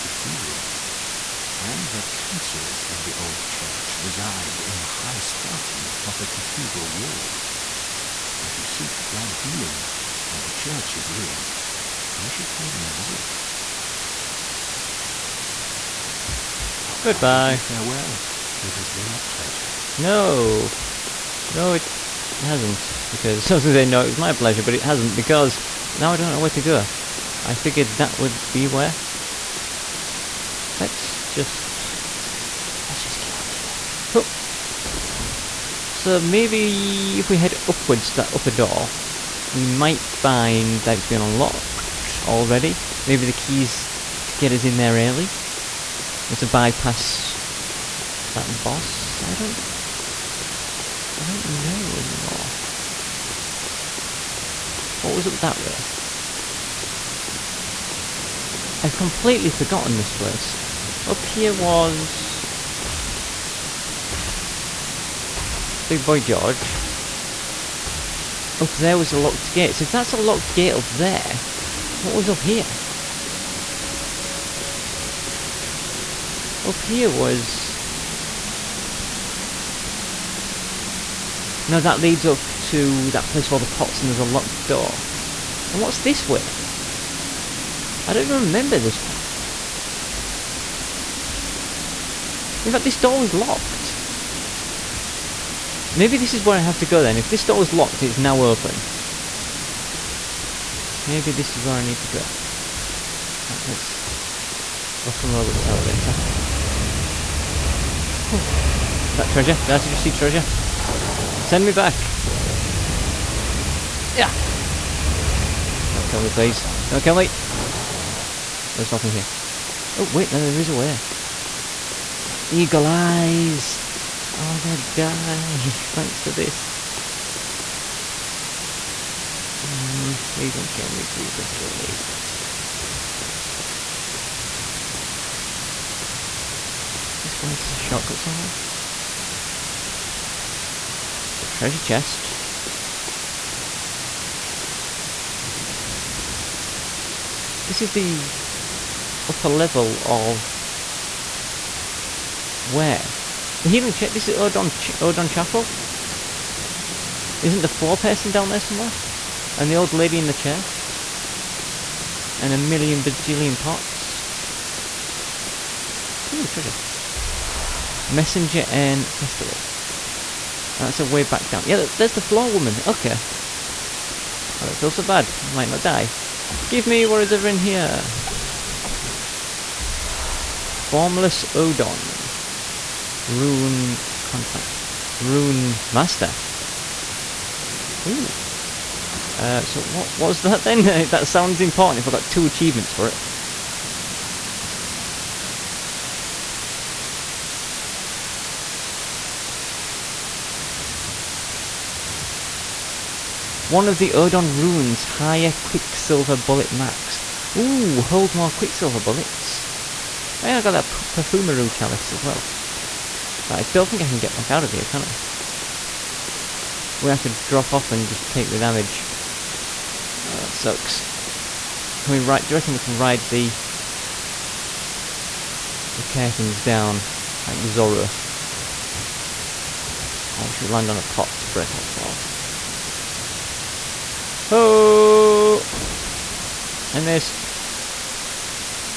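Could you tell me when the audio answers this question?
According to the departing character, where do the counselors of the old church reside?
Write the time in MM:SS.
00:05.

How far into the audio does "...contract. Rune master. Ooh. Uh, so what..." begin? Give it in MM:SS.
03:04.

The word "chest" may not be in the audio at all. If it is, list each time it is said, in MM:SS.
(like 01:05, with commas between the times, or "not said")
02:21, 02:33.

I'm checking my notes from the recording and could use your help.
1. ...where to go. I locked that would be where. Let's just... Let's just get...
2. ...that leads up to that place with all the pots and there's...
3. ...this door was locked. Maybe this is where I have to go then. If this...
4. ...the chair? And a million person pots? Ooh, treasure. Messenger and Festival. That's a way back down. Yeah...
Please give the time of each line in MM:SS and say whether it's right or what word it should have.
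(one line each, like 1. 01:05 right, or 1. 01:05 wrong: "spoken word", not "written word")
1. 00:26 wrong: "figured", not "locked"
2. 01:21 right
3. 01:32 right
4. 02:40 wrong: "bajillion", not "person".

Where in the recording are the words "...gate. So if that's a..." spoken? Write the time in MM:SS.
01:09.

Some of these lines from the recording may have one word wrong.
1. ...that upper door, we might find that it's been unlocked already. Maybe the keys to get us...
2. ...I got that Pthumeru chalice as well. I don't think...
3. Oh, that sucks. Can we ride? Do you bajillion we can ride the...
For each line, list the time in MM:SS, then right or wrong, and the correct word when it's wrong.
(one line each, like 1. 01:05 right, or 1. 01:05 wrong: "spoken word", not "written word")
1. 00:38 right
2. 03:30 right
3. 03:40 wrong: "reckon", not "bajillion".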